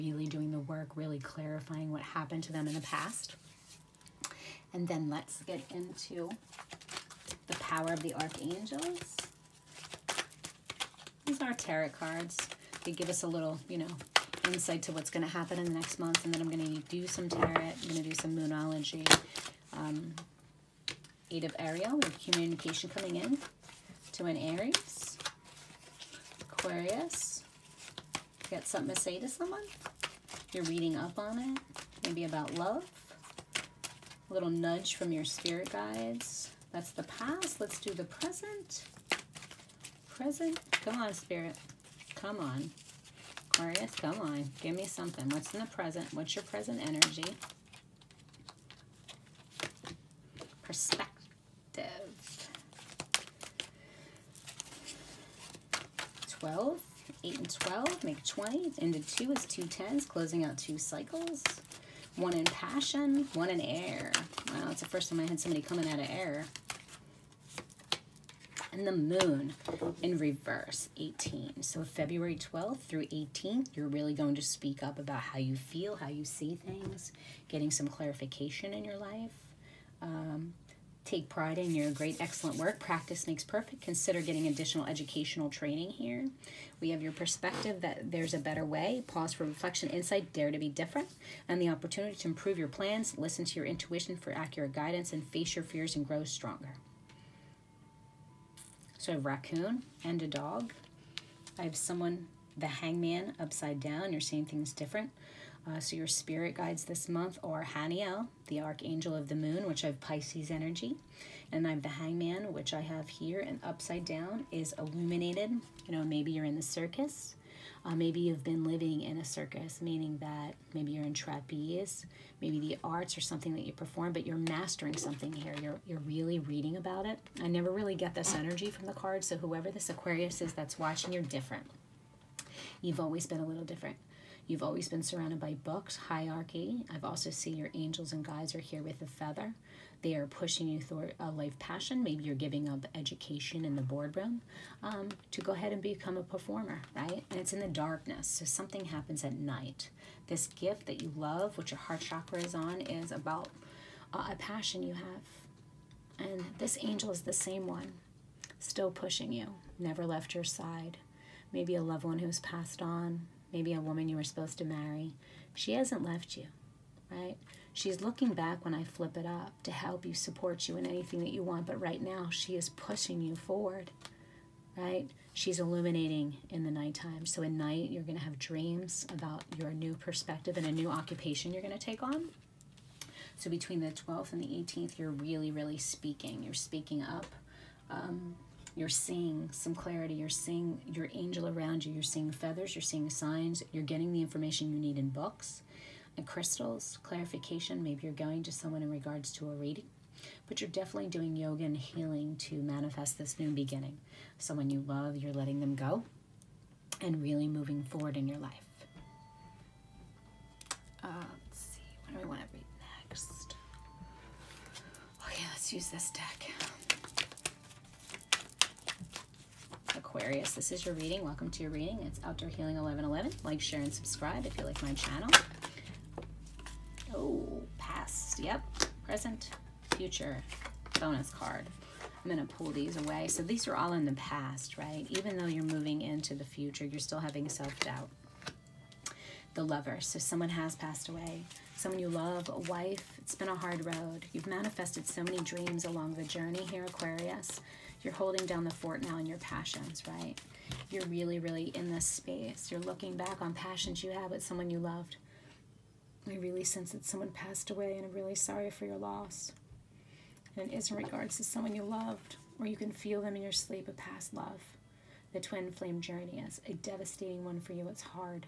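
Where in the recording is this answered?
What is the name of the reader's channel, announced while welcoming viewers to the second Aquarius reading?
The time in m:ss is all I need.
3:42.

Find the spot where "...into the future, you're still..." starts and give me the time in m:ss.
3:56.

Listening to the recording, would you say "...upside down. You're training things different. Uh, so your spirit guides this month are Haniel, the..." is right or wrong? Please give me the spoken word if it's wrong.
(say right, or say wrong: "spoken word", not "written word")
wrong: "seeing", not "training".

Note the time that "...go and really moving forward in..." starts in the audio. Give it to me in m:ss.
3:25.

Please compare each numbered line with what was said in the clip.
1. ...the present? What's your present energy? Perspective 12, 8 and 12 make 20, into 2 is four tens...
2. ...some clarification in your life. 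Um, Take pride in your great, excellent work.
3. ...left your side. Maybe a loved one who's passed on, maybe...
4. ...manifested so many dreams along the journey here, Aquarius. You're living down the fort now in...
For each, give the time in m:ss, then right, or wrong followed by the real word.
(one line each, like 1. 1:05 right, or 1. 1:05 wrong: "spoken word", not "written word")
1. 0:45 wrong: "two", not "four"
2. 1:17 right
3. 2:40 right
4. 4:04 wrong: "holding", not "living".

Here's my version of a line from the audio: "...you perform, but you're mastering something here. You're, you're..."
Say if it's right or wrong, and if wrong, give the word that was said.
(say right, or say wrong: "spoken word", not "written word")
right.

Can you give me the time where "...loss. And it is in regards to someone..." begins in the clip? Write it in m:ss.
4:18.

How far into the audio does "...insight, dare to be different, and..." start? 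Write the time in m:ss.
1:29.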